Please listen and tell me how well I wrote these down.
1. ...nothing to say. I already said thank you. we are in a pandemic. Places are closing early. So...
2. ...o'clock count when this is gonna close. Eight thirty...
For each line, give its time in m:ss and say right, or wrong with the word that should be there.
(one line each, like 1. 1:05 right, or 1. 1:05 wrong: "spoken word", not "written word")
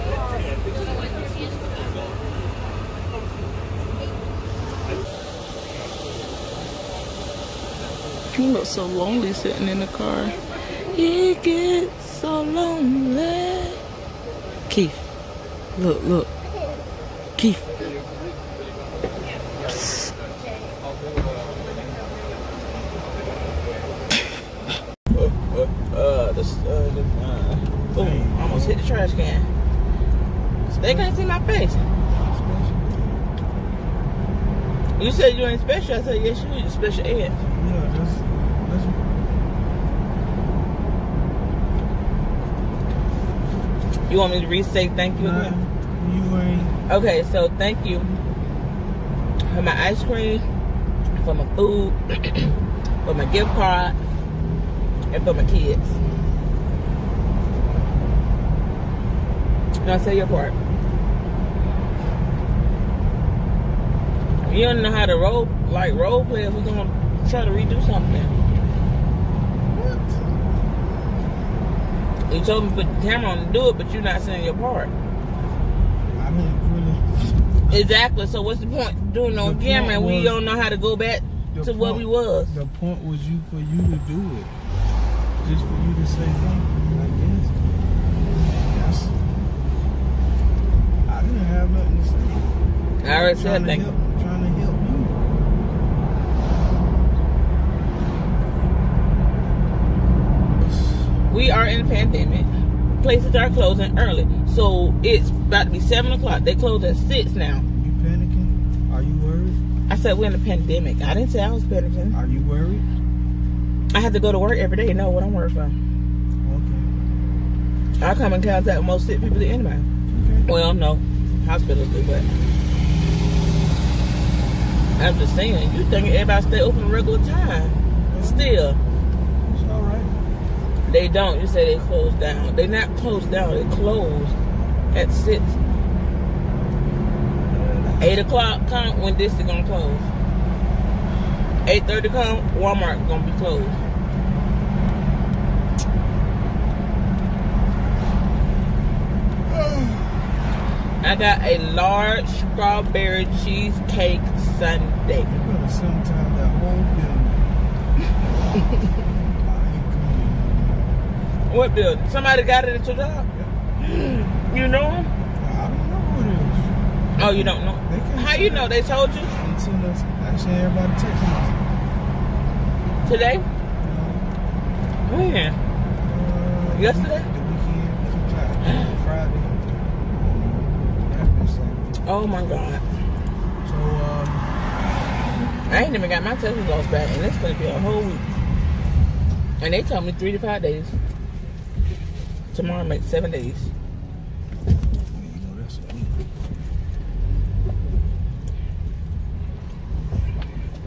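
1. 1:31 right
2. 2:18 right.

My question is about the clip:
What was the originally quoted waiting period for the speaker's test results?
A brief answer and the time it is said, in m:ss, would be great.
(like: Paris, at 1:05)
3 to 5 days, at 3:10.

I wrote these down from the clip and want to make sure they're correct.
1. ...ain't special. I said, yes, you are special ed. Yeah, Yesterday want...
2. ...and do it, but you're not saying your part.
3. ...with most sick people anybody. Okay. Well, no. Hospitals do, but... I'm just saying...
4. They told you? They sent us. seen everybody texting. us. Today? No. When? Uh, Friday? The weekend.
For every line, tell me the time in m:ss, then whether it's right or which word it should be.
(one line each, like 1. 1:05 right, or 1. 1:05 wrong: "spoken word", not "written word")
1. 0:35 wrong: "You", not "Yesterday"
2. 1:13 right
3. 1:58 right
4. 2:48 wrong: "Yesterday", not "Friday".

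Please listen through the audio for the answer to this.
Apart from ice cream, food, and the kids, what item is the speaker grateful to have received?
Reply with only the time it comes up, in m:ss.
0:53.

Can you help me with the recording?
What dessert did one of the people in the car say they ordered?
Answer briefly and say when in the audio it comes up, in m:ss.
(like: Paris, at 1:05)
large strawberry cheesecake sundae, at 2:31.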